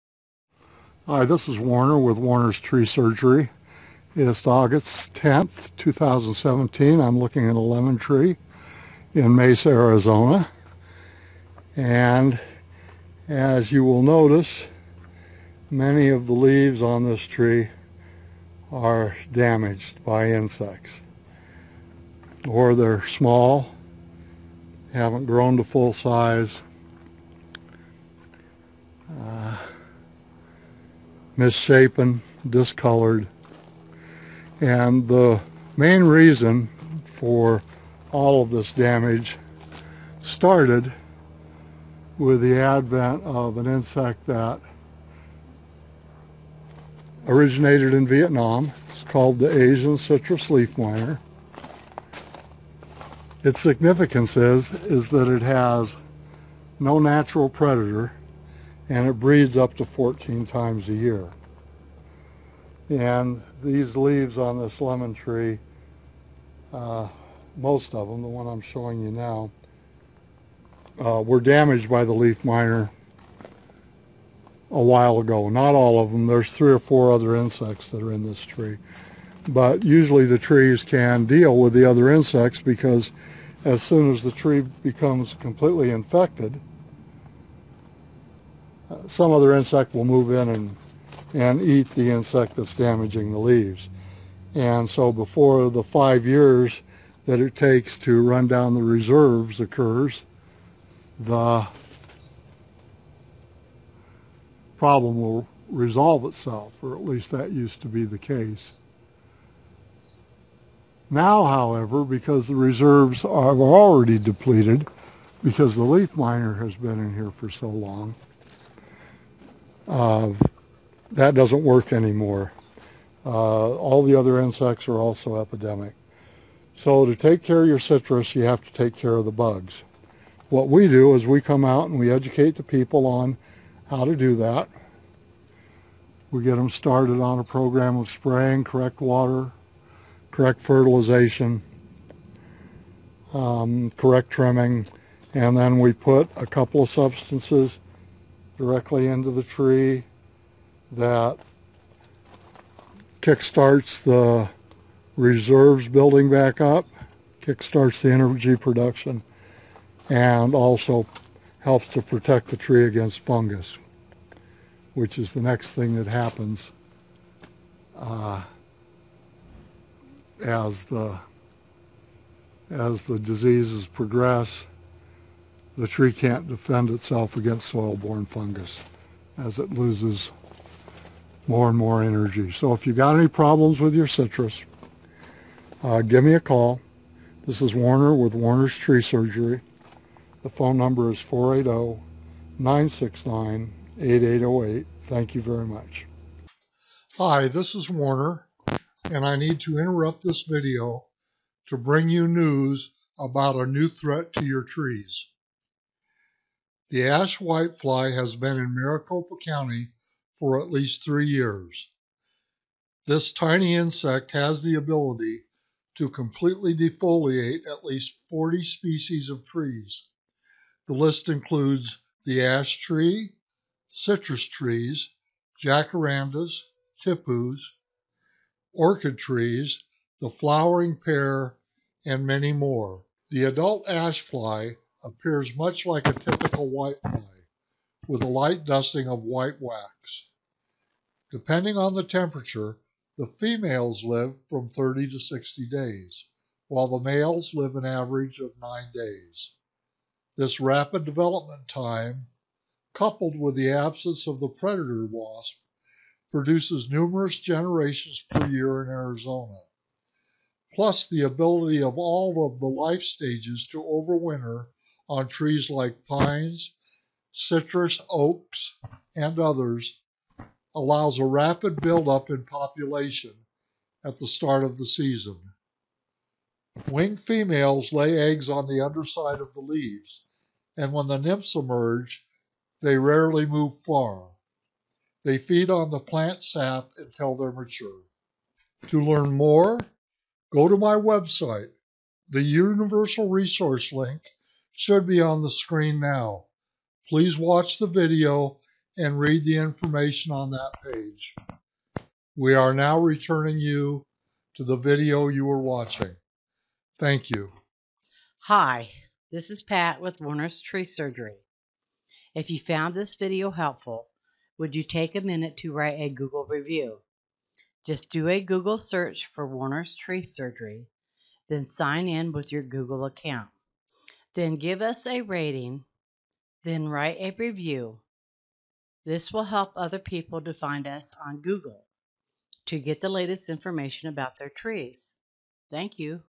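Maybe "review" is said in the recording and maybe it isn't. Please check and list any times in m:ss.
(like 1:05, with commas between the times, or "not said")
5:16, 5:27.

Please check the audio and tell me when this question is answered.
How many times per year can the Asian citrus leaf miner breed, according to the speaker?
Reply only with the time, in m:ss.
0:59.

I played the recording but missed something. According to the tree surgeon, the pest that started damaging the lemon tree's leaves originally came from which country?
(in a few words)
Vietnam.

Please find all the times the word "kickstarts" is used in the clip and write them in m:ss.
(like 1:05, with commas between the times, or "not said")
2:33, 2:37.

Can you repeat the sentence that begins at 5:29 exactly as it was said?
This will help other people to find us on Google to get the latest information about their trees.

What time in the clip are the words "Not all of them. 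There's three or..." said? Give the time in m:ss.
1:15.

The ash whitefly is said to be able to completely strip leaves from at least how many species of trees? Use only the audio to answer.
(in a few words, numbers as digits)
40.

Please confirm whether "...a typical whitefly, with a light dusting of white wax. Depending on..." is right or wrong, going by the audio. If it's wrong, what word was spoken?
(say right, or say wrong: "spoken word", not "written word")
right.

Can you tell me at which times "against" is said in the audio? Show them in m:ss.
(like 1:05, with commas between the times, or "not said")
2:42, 2:57.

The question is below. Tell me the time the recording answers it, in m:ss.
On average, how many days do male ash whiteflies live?
4:08.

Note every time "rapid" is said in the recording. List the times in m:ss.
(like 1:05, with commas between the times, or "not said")
4:10, 4:31.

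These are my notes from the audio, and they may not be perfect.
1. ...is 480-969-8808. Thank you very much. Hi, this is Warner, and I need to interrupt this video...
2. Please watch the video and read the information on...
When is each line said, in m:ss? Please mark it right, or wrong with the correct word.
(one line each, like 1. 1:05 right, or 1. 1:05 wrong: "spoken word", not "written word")
1. 3:11 right
2. 4:57 right.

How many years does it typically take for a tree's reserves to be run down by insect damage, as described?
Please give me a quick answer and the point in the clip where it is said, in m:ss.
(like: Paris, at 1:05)
5, at 1:35.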